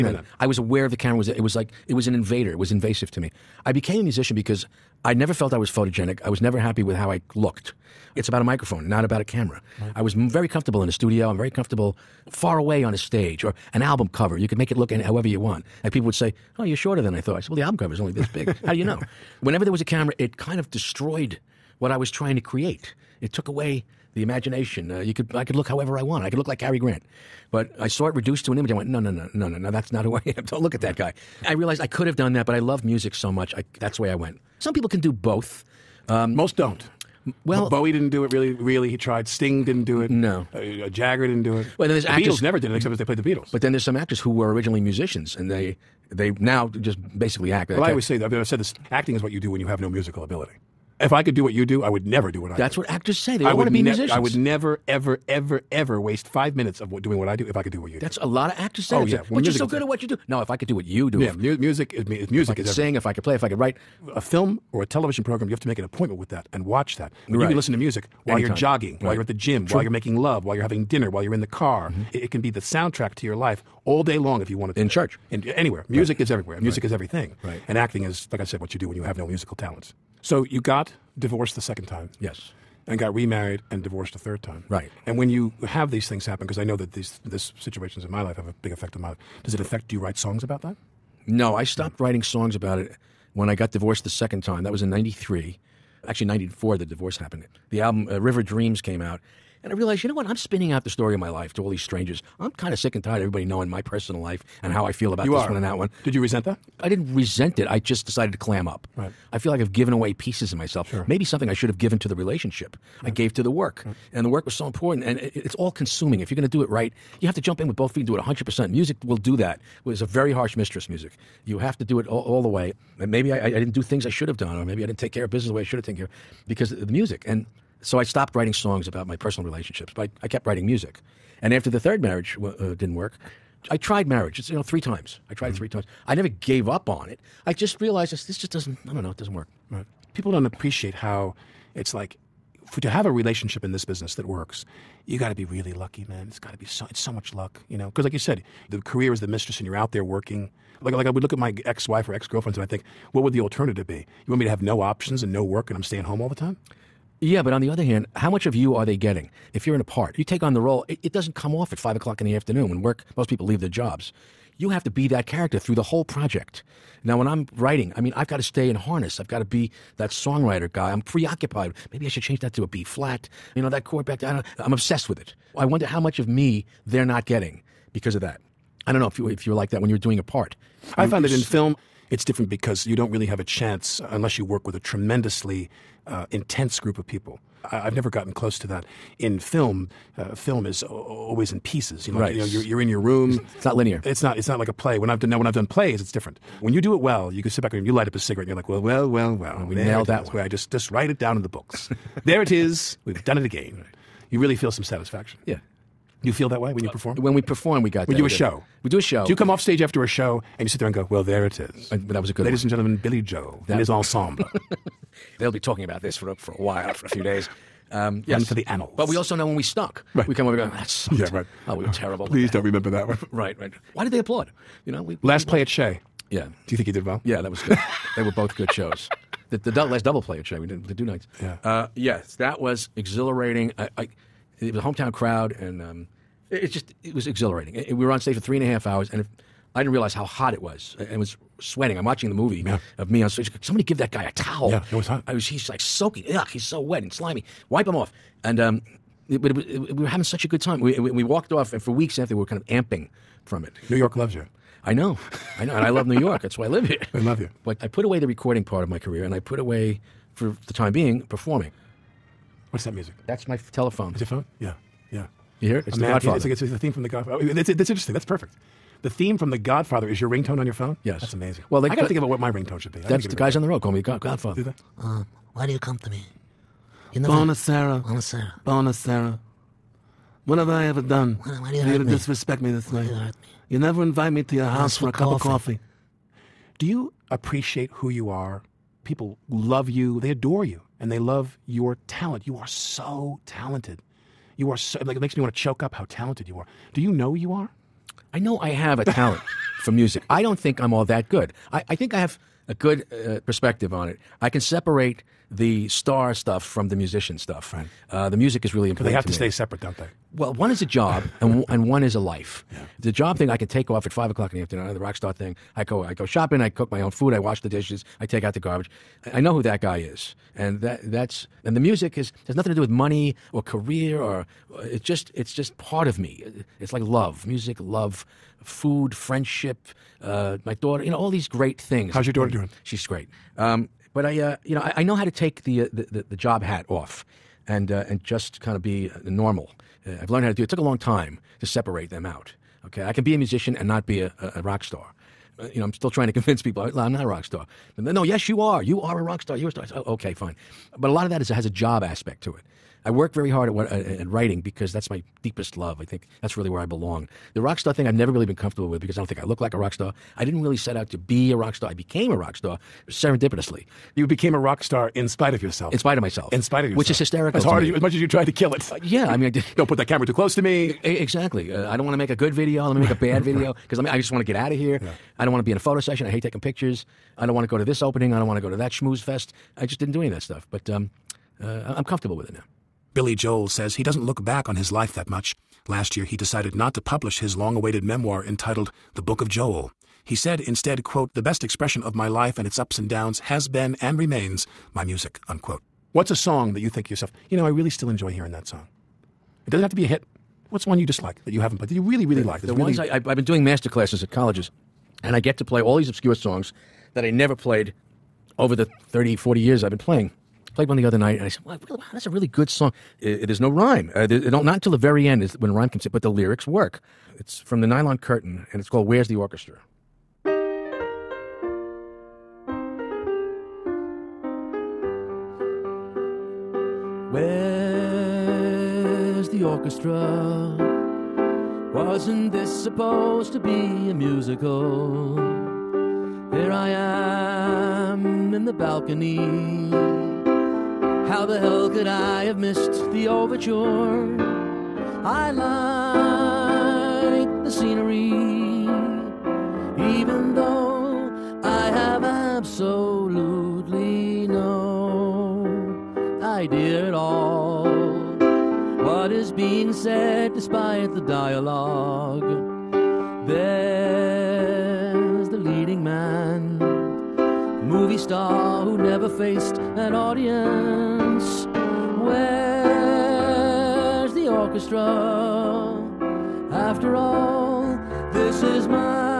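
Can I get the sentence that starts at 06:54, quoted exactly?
Uh, there, not until the very end is when rhyme comes in, but the lyrics work.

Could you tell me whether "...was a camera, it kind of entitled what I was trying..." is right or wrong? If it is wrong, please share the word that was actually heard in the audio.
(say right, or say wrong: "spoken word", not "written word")
wrong: "destroyed", not "entitled".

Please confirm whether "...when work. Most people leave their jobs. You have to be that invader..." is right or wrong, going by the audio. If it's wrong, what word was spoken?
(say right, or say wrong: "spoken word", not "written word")
wrong: "character", not "invader".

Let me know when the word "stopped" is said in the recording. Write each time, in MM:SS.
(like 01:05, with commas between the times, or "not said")
01:31, 02:08.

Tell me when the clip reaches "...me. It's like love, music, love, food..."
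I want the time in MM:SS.
05:26.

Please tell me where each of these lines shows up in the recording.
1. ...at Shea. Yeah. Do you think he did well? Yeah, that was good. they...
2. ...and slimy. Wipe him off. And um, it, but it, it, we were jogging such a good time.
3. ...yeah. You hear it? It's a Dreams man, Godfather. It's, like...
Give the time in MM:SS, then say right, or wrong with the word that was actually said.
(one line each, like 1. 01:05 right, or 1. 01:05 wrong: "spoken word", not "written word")
1. 03:45 right
2. 04:07 wrong: "having", not "jogging"
3. 04:25 wrong: "The", not "Dreams".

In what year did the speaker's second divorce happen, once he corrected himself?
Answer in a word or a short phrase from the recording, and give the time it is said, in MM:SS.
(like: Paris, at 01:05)
1994, at 01:36.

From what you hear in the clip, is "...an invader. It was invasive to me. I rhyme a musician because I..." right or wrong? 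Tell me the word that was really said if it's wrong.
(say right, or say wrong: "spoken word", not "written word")
wrong: "became", not "rhyme".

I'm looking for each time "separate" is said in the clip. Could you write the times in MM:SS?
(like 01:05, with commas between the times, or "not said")
05:04, 05:09, 05:41.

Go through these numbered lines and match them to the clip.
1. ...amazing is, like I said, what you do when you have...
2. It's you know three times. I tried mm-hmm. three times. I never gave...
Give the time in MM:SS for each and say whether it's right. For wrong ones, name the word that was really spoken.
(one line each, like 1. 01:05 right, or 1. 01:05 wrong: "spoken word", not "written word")
1. 01:17 wrong: "acting", not "amazing"
2. 02:14 right.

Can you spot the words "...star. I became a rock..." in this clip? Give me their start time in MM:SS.
06:01.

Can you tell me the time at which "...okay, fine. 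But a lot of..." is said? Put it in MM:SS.
05:50.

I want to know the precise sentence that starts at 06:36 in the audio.
What's a song that you think to yourself, you know, I really still enjoy hearing that song?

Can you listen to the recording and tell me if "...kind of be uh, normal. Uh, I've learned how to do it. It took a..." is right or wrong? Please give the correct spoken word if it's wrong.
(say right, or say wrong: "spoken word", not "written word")
right.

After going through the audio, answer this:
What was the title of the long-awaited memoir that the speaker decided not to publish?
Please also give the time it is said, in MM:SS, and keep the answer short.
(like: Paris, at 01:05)
The Book of Joel, at 06:29.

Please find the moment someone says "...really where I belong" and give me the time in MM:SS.
05:56.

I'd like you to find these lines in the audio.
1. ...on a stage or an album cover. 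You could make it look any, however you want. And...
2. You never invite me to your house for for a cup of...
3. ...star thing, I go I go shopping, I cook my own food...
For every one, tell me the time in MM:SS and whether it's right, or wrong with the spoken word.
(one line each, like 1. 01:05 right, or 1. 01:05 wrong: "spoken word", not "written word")
1. 00:12 right
2. 04:43 right
3. 05:15 right.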